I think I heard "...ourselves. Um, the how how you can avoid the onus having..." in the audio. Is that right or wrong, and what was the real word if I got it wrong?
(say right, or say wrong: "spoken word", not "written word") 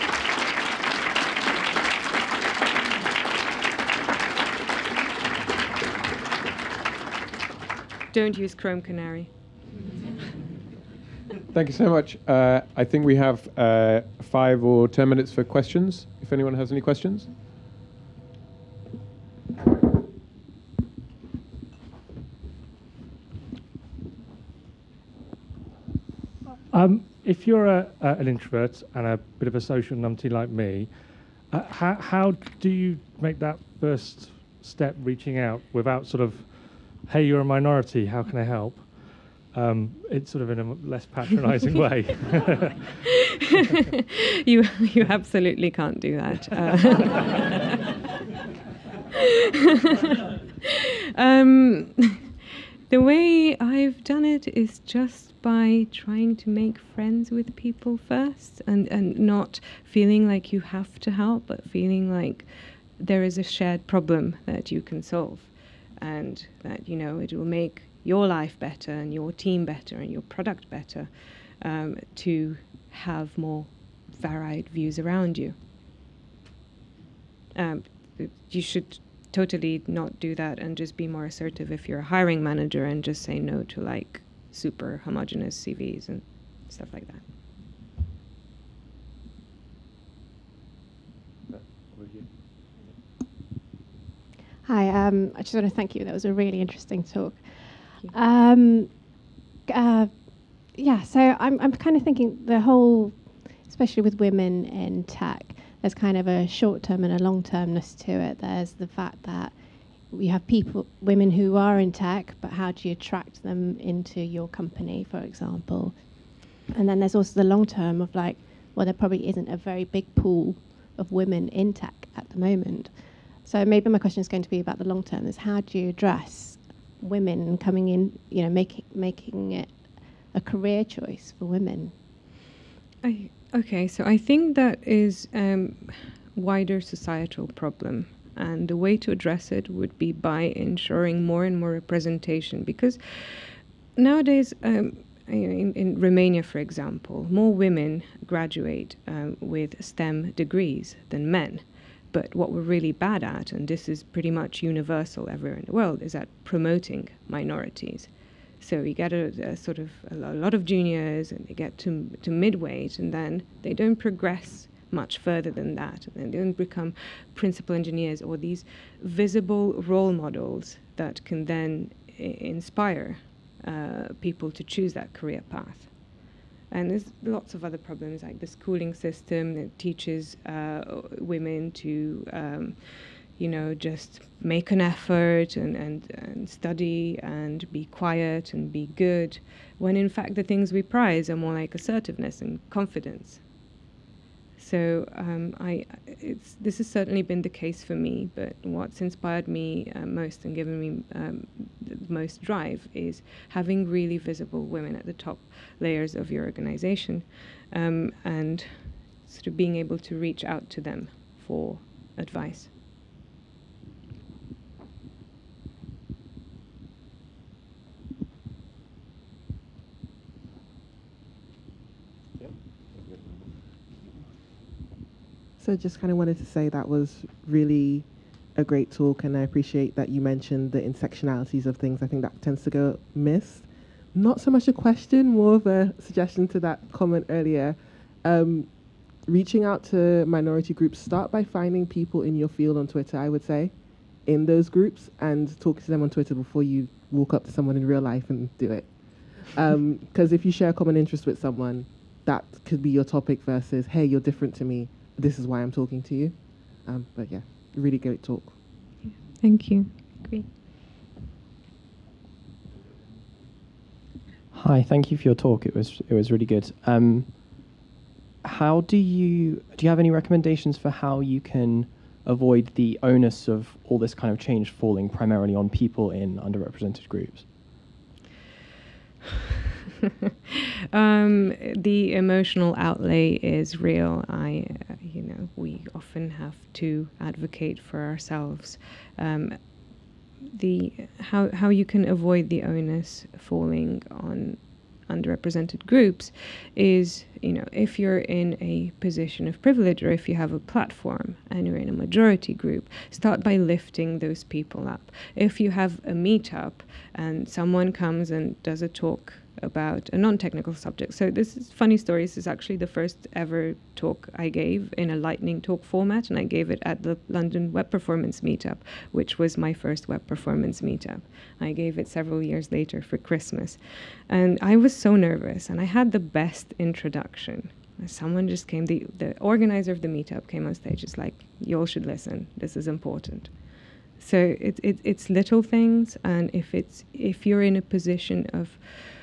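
wrong: "falling", not "having".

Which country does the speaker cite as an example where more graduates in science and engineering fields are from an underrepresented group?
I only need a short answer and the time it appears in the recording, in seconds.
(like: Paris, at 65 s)
Romania, at 146 s.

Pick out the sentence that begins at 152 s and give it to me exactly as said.
But what we're really bad at, and this is pretty much universal everywhere in the world, is at promoting minorities.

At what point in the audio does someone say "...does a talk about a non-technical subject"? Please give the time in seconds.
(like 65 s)
308 s.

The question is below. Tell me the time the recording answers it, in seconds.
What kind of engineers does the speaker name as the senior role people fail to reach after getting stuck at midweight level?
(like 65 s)
167 s.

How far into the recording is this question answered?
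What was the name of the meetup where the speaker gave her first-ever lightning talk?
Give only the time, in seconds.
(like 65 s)
317 s.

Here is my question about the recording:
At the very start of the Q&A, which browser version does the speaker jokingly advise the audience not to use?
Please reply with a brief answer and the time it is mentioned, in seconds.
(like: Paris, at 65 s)
Chrome Canary, at 8 s.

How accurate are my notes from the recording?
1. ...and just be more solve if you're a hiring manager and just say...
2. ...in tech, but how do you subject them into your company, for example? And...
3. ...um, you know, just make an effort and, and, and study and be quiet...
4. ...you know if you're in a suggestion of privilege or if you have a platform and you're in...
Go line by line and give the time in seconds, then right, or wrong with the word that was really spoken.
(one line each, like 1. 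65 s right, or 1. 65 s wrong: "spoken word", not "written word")
1. 80 s wrong: "assertive", not "solve"
2. 111 s wrong: "attract", not "subject"
3. 182 s right
4. 297 s wrong: "position", not "suggestion".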